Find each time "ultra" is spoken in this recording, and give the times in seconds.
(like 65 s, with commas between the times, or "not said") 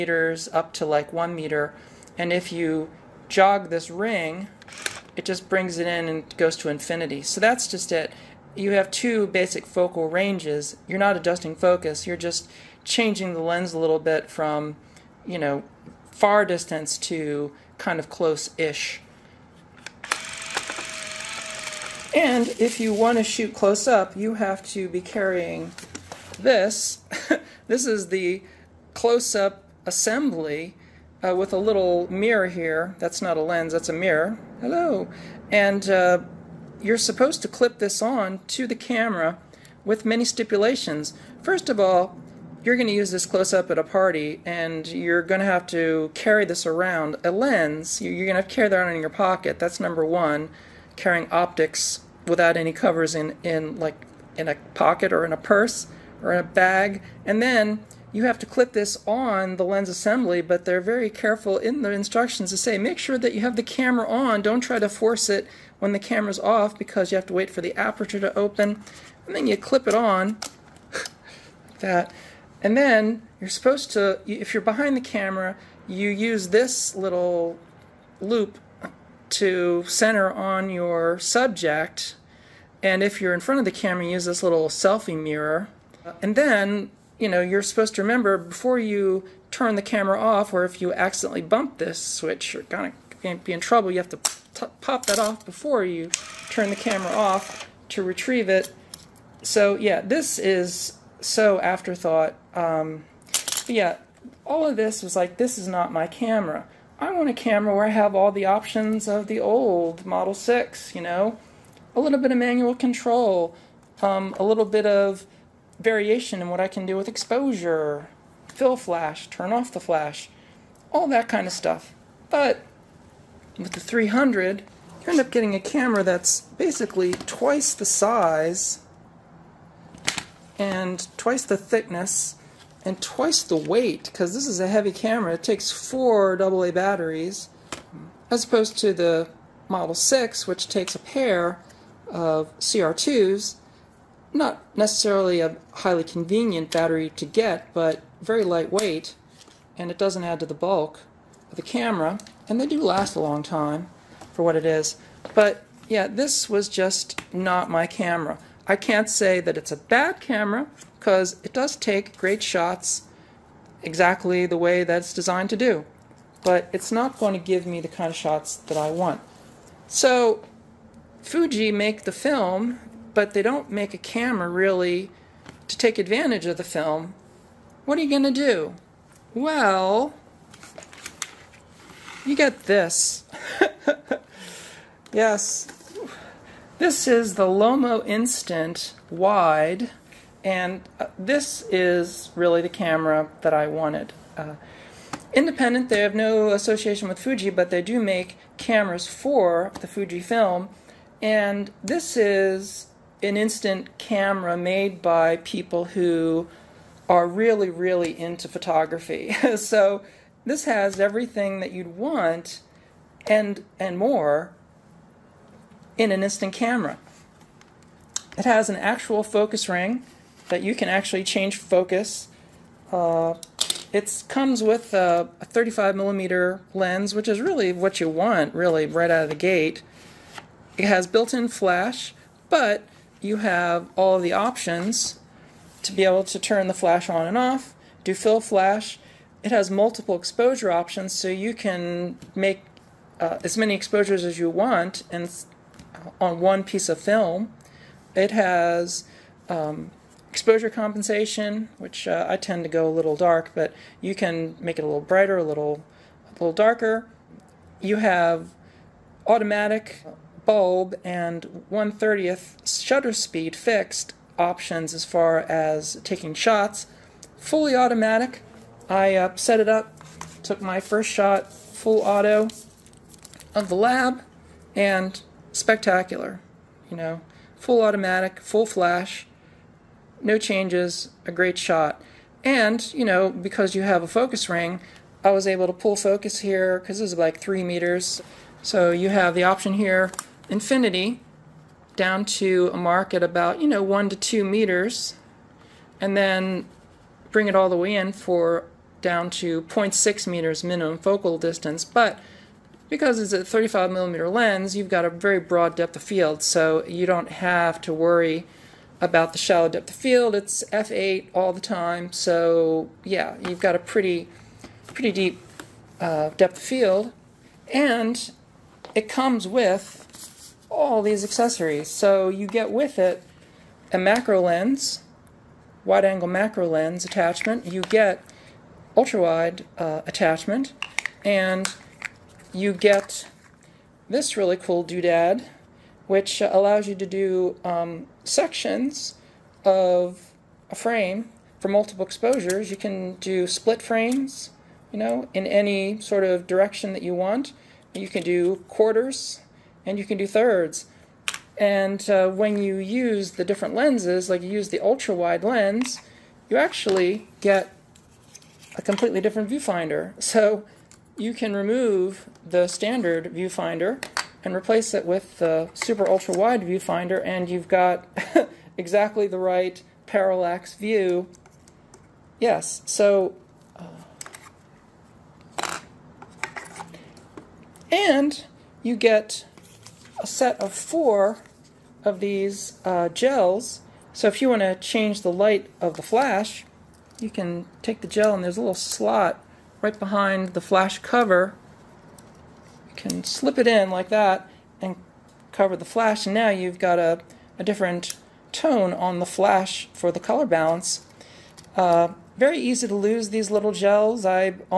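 328 s, 354 s, 366 s.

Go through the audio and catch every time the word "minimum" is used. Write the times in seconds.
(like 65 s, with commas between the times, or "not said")
300 s.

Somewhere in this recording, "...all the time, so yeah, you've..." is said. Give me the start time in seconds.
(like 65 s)
311 s.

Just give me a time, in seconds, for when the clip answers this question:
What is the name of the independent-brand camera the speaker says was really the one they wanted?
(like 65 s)
187 s.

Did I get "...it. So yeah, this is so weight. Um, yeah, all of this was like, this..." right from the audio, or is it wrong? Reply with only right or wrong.
wrong.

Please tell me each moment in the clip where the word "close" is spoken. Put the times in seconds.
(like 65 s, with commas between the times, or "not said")
18 s, 23 s, 28 s, 43 s.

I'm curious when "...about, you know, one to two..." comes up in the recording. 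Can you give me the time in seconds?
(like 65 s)
293 s.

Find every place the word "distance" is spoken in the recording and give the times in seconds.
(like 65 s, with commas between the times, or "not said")
16 s, 301 s.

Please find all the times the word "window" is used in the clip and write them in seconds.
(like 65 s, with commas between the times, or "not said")
not said.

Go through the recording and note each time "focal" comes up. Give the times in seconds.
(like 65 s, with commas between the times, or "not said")
9 s, 300 s.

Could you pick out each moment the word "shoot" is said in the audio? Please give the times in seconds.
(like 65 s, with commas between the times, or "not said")
23 s.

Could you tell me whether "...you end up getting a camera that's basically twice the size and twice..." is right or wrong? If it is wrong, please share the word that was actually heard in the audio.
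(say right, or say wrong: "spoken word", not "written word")
right.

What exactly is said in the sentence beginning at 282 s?
And, you know, because you have a focus ring, I was able to pull focus here because this is like three meters.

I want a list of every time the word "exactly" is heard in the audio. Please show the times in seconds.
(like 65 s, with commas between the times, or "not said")
163 s, 368 s.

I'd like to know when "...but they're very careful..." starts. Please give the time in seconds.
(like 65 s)
60 s.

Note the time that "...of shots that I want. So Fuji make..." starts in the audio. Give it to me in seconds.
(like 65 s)
168 s.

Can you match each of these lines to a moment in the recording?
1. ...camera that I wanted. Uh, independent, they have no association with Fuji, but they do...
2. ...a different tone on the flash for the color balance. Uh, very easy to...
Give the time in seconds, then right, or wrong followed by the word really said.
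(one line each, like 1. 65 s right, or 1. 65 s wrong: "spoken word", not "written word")
1. 192 s right
2. 397 s right.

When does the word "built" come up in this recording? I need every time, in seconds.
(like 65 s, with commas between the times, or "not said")
231 s.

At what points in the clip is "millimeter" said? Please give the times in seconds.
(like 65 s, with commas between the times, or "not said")
225 s, 303 s.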